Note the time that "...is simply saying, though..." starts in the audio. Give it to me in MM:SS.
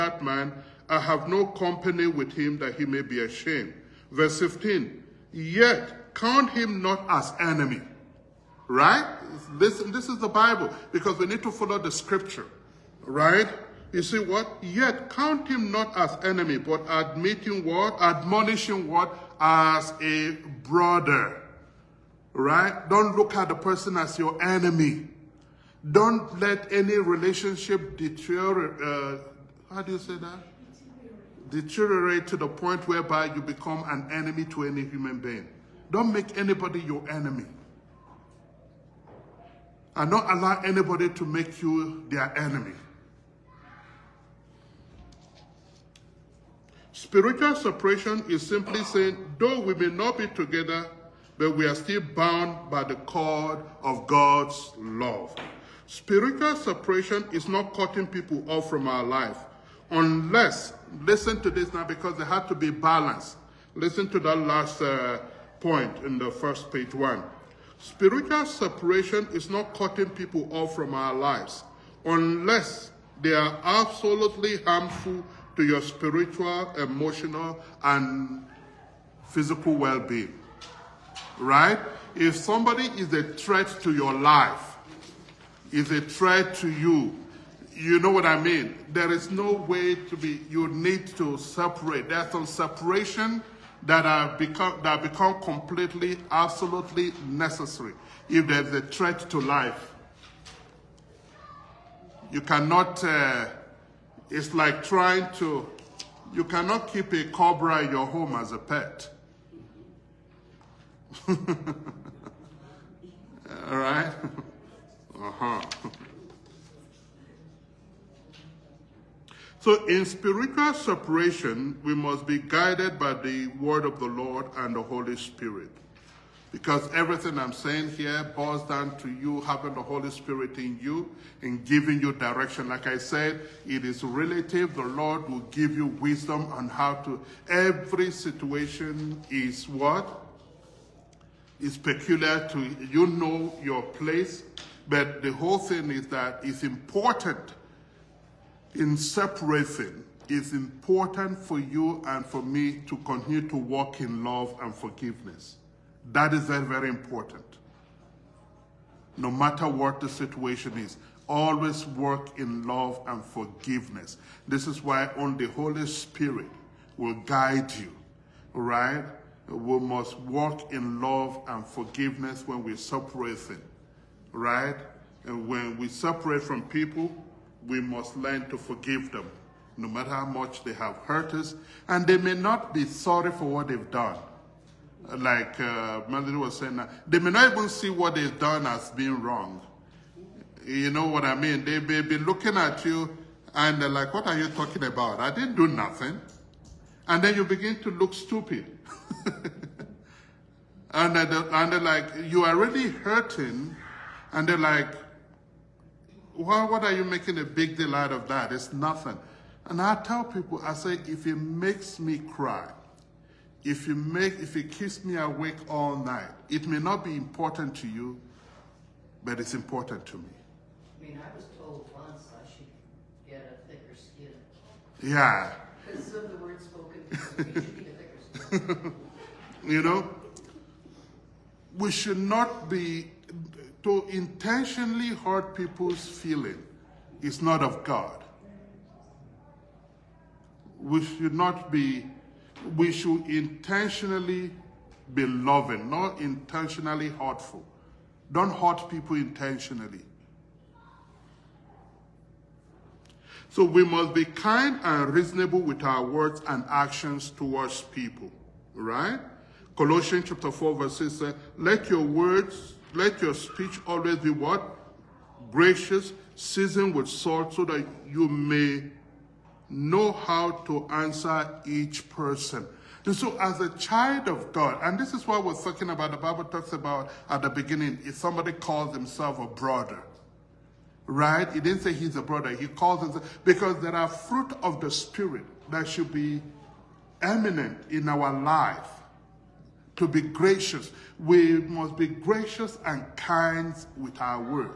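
00:48.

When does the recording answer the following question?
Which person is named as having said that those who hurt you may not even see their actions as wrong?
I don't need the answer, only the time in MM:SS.
03:06.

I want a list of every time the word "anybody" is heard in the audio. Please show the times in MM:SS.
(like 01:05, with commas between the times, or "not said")
00:36, 00:40.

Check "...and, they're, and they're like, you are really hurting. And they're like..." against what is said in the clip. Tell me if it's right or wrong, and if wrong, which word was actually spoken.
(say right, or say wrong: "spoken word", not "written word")
right.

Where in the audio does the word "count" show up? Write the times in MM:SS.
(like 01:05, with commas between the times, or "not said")
00:06, 00:15.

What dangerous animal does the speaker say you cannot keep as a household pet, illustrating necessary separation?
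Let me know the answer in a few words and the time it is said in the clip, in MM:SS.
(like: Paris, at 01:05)
cobra, at 01:47.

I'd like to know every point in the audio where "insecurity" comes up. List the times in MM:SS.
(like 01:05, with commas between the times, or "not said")
not said.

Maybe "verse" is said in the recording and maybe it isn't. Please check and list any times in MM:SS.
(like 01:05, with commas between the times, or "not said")
00:04, 04:20.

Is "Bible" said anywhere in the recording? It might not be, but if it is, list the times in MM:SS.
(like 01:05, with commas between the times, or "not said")
00:10, 04:36.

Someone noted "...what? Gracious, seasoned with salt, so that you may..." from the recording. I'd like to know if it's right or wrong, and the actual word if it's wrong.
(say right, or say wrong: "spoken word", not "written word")
right.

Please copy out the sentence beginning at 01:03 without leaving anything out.
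Listen to that last uh, point in the first page one.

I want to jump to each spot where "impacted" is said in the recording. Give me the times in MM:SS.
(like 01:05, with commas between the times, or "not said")
not said.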